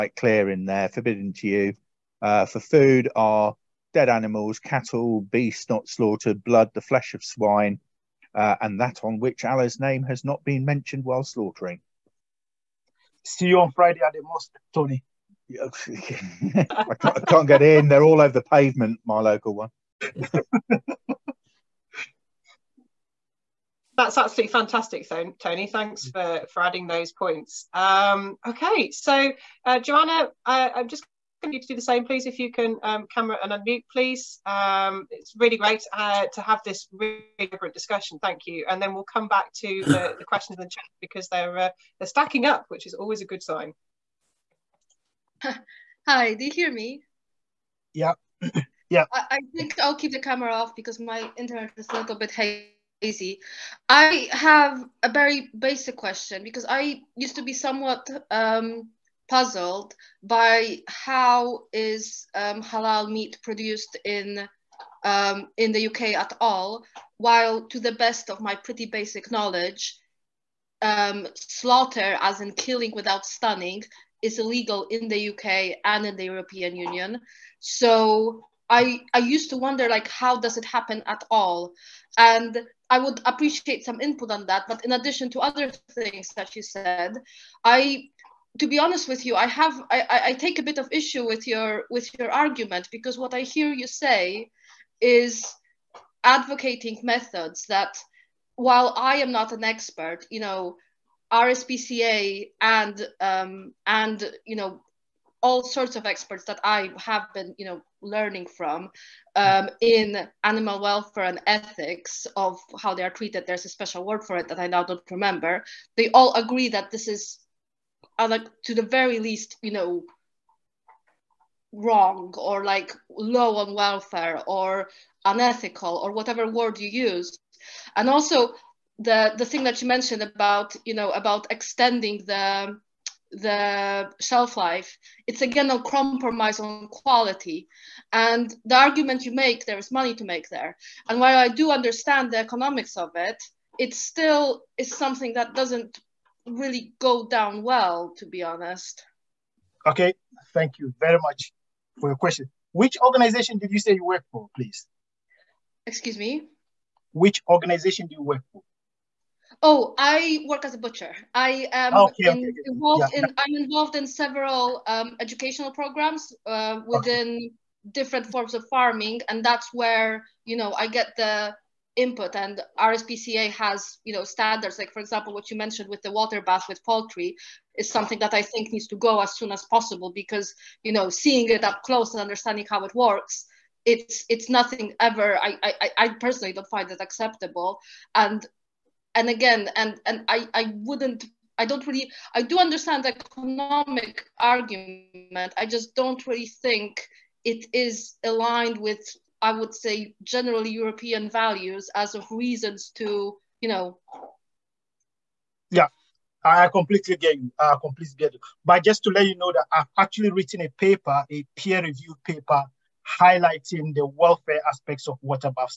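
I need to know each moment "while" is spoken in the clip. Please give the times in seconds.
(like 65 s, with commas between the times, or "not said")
11 s, 67 s, 98 s, 141 s.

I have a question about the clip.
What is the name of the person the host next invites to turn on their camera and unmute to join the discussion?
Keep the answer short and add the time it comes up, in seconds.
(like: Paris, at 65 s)
Joanna, at 29 s.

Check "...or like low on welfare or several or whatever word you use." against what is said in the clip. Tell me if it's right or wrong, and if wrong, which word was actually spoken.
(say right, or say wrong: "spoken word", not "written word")
wrong: "unethical", not "several".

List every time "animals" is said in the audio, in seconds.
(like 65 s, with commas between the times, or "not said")
4 s, 110 s.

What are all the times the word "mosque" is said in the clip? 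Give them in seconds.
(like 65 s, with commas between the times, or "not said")
14 s.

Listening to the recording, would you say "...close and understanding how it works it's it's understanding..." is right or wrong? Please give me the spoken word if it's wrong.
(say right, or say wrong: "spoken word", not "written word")
wrong: "nothing", not "understanding".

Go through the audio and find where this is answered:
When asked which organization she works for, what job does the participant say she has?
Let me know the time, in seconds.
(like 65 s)
160 s.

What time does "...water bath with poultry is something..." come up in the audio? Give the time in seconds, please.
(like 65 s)
176 s.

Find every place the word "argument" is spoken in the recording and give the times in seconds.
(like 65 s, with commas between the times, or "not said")
92 s, 138 s, 194 s.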